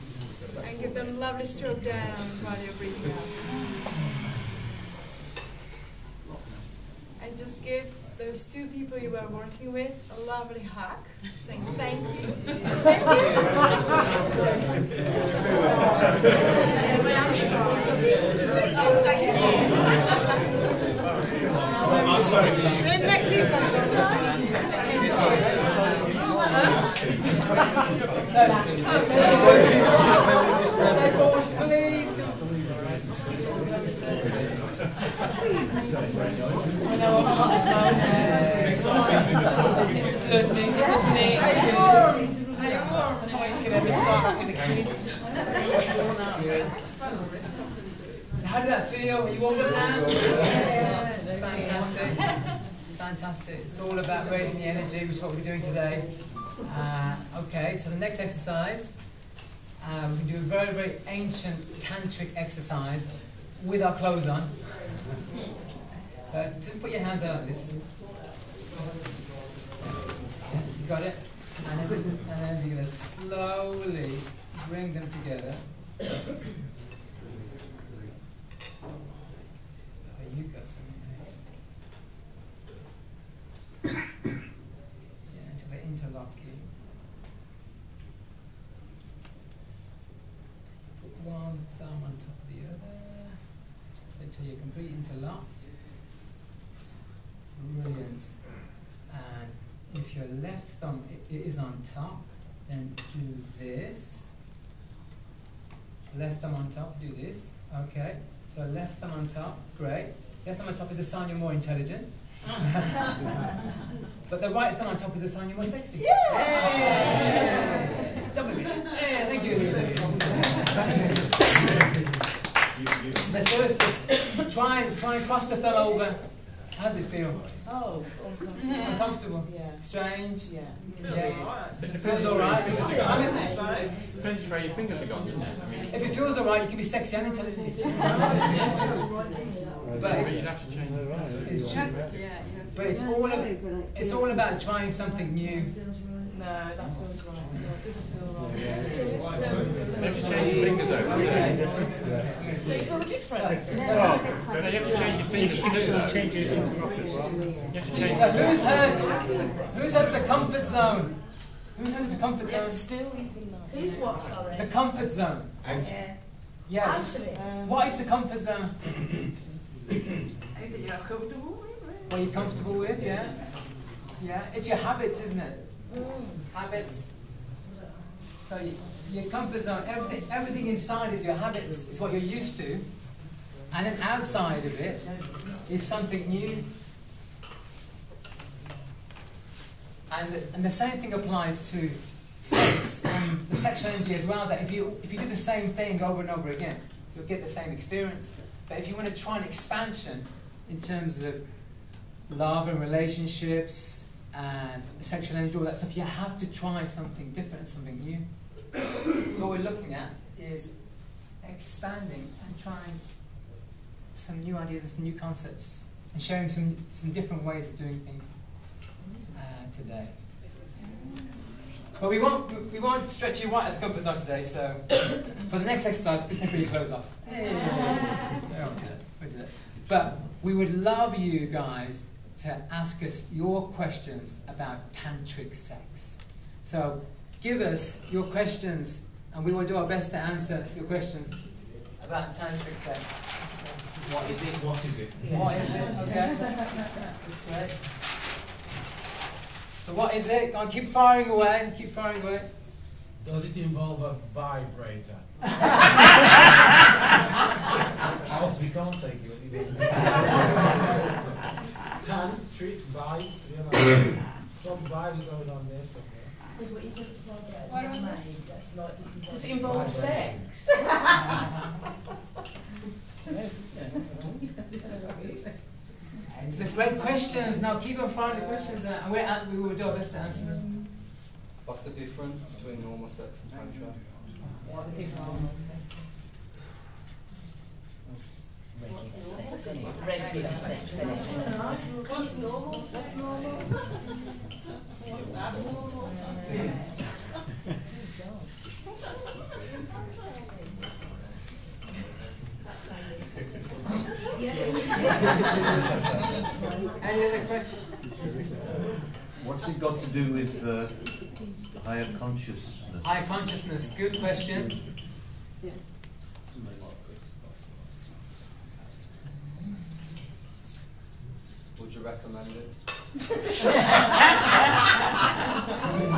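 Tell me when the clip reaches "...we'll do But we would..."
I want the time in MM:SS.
03:49.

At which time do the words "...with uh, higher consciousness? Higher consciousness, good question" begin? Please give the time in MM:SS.
05:10.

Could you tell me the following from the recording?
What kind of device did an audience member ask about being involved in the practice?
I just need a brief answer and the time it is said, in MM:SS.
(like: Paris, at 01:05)
A vibrator, at 04:14.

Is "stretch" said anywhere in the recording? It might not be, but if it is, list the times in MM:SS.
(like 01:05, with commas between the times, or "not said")
03:43.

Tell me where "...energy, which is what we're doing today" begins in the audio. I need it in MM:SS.
00:54.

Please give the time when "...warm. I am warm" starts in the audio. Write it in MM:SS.
00:41.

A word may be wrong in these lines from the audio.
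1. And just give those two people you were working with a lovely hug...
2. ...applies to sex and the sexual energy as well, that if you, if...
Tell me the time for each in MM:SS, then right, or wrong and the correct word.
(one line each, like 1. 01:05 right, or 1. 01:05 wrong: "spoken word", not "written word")
1. 00:07 right
2. 03:11 right.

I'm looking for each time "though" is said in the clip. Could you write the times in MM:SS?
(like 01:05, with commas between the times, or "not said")
02:30, 02:43.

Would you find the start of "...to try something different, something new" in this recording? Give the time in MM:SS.
03:26.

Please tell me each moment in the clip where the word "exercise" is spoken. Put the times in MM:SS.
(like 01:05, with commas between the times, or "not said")
00:58, 01:02, 03:45.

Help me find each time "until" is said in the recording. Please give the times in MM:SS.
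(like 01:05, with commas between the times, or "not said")
01:25.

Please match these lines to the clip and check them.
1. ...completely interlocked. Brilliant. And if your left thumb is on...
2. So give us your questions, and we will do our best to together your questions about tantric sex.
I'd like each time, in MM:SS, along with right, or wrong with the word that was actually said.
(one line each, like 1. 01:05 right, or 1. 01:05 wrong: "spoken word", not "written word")
1. 01:34 right
2. 03:56 wrong: "answer", not "together".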